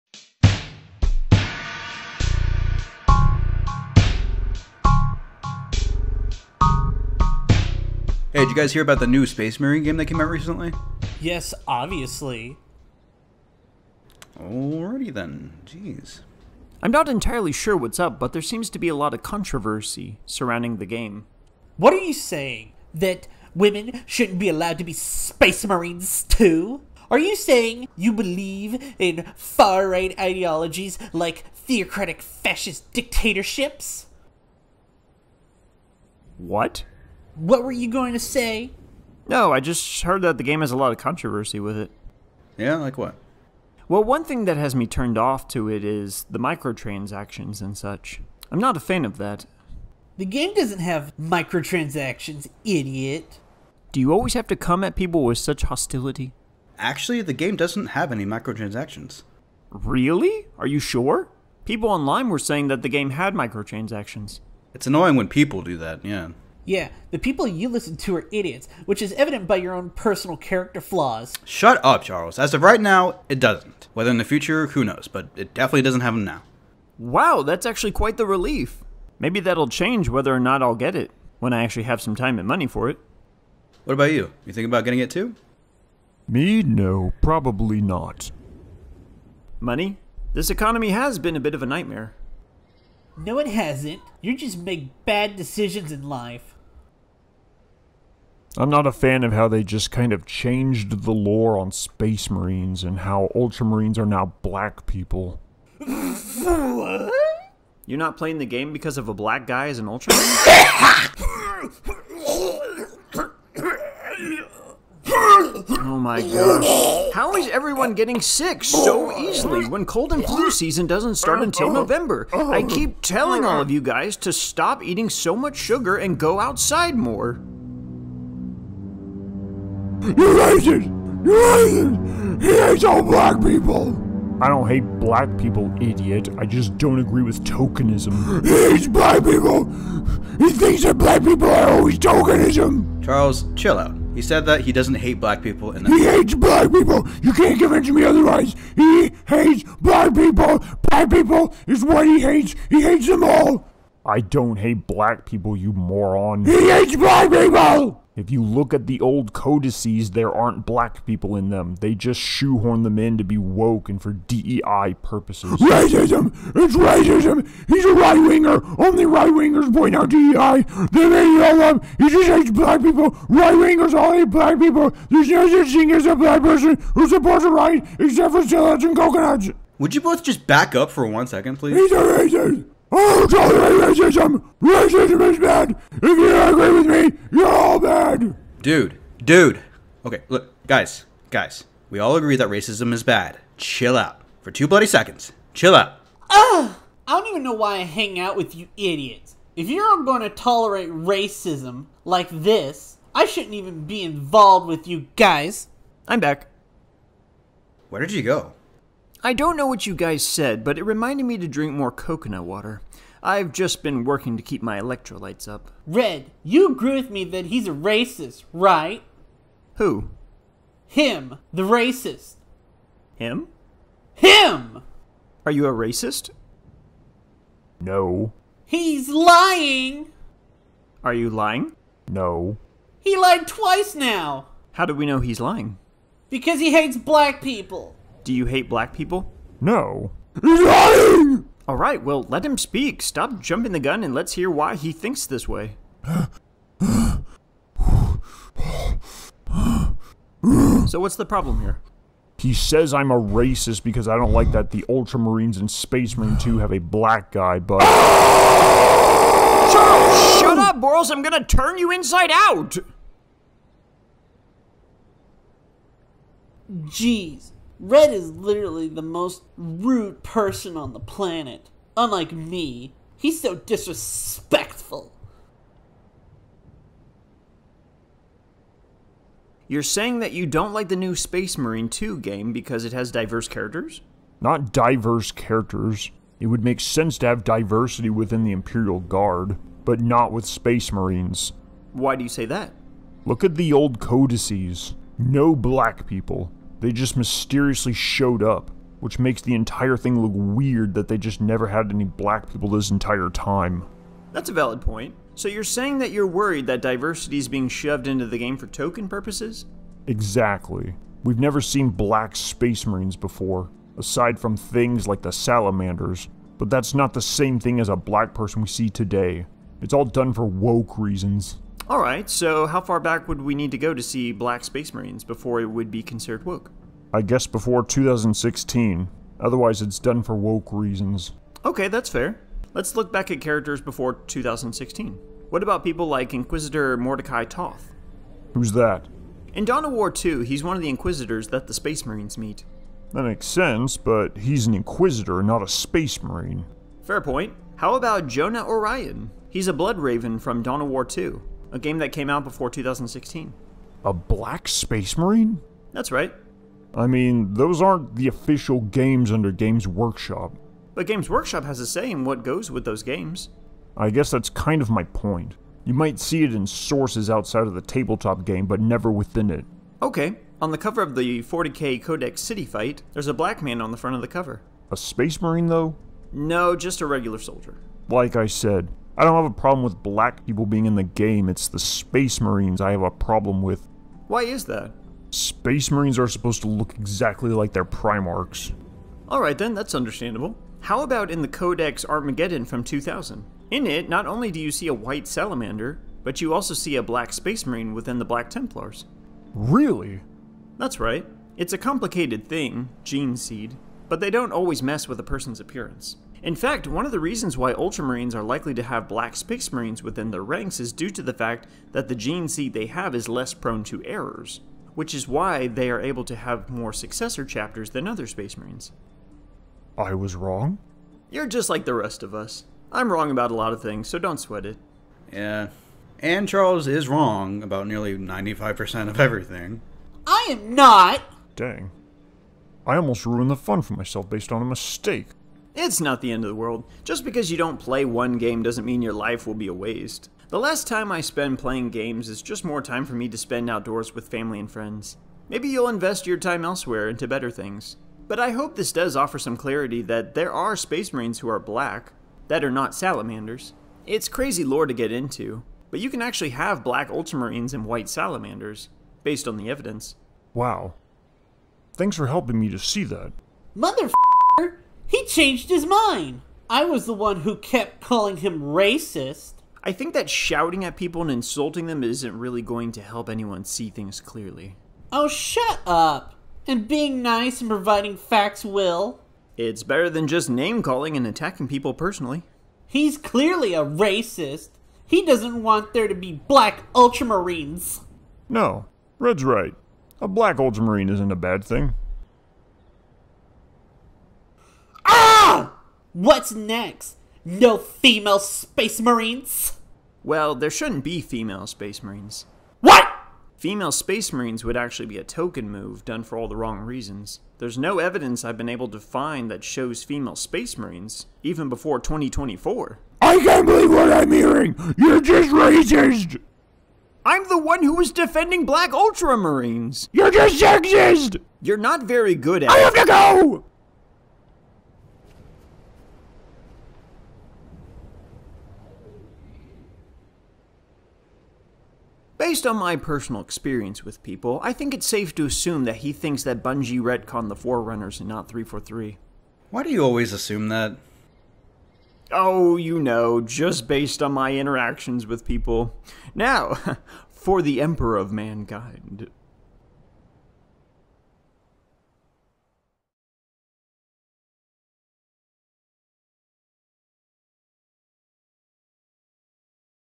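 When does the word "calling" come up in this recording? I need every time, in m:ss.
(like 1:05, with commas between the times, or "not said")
7:47, 8:00.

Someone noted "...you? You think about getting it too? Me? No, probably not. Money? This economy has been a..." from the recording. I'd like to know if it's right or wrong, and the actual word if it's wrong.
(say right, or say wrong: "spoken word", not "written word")
right.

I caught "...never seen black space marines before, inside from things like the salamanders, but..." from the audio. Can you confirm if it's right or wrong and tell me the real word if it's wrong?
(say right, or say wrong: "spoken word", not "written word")
wrong: "aside", not "inside".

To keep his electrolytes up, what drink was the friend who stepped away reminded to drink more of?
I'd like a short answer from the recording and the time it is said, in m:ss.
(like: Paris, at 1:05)
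coconut water, at 3:31.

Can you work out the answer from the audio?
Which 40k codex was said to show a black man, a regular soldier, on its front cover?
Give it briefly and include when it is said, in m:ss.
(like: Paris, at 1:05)
City Fight, at 6:12.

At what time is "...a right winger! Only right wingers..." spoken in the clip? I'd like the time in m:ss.
2:47.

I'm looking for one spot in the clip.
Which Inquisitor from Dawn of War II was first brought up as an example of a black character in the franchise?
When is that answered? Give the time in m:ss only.
5:36.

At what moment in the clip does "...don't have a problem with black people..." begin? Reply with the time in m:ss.
6:19.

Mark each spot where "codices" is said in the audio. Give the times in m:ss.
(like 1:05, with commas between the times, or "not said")
2:39, 4:53.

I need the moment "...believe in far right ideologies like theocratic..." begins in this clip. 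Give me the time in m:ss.
0:28.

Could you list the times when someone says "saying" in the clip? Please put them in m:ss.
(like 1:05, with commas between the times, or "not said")
0:22, 0:27, 1:02, 4:39, 5:05.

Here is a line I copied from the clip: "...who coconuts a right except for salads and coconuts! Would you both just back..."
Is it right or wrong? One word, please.
wrong.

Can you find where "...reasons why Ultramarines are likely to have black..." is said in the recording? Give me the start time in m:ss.
6:47.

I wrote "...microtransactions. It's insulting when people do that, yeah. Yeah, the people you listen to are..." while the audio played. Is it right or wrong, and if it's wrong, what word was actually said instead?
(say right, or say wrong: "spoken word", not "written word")
wrong: "annoying", not "insulting".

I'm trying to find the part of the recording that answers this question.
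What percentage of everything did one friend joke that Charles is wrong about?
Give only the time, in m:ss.
7:08.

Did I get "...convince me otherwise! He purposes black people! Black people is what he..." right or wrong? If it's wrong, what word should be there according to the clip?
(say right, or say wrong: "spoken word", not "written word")
wrong: "hates", not "purposes".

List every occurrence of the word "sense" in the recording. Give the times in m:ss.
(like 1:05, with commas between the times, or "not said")
4:46, 5:43.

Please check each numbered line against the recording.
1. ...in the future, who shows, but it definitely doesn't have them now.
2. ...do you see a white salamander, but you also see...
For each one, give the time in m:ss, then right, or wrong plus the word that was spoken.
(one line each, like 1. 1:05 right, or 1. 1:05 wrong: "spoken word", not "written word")
1. 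1:14 wrong: "knows", not "shows"
2. 6:34 right.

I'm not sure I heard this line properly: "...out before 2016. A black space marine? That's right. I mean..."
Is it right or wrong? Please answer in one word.
right.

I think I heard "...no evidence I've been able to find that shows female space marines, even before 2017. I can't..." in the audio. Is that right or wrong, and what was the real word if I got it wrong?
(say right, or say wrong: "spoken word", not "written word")
wrong: "2024", not "2017".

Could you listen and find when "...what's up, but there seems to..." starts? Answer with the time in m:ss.
0:17.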